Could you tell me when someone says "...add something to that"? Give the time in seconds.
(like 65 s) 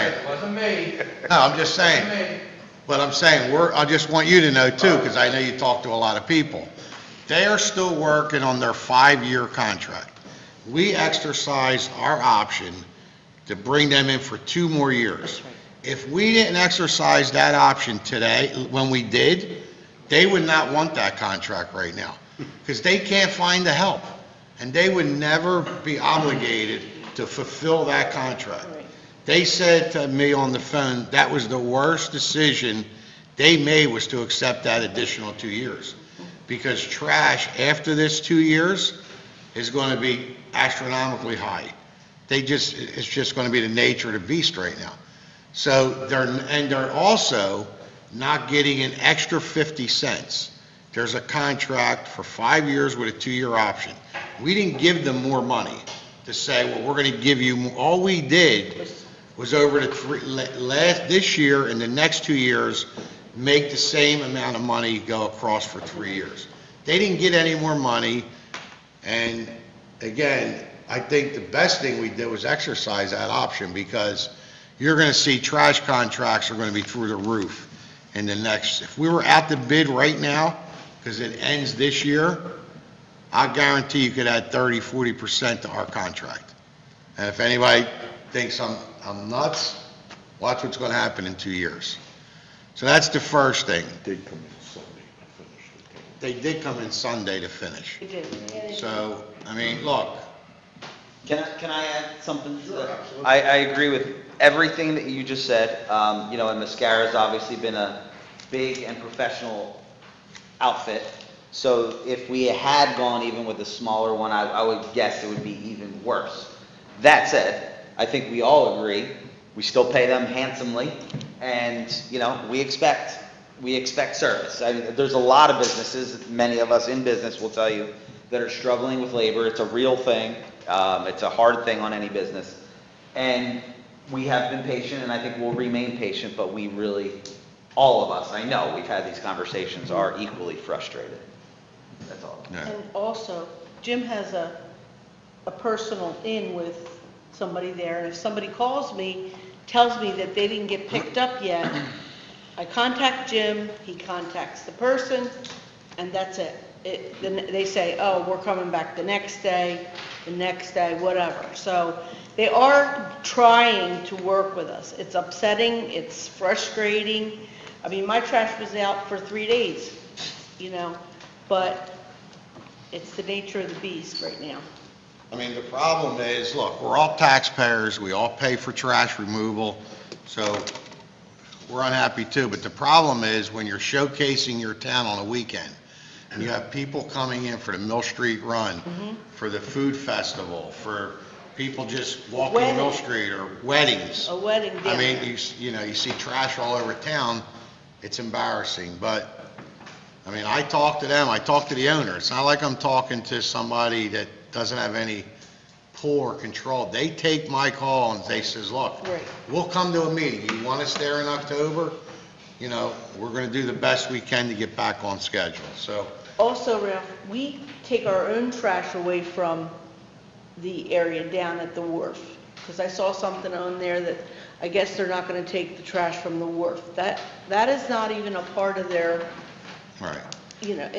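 101 s.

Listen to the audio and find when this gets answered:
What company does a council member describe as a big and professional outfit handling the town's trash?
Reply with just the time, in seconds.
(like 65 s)
106 s.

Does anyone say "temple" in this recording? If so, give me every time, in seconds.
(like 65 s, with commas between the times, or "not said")
not said.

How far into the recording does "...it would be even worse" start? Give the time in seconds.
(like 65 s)
115 s.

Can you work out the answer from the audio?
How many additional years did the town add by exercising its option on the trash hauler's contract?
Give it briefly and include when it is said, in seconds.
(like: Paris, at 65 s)
2, at 14 s.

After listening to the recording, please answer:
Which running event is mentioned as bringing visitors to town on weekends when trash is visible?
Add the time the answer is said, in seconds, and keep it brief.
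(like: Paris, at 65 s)
Mill Street Run, at 187 s.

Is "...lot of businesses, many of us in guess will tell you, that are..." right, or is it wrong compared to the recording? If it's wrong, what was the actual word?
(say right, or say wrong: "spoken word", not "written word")
wrong: "business", not "guess".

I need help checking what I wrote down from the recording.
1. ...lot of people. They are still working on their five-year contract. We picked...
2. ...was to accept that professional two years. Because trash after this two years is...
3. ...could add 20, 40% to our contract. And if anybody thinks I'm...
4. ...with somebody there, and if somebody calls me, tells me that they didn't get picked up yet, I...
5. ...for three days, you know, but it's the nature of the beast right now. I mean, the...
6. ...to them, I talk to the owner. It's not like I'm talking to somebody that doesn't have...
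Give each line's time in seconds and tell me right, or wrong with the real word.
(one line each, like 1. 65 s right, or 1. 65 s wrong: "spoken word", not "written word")
1. 5 s wrong: "exercised", not "picked"
2. 33 s wrong: "additional", not "professional"
3. 84 s wrong: "30", not "20"
4. 146 s right
5. 169 s right
6. 200 s right.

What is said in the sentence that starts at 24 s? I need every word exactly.
And they would never be obligated to fulfill that contract.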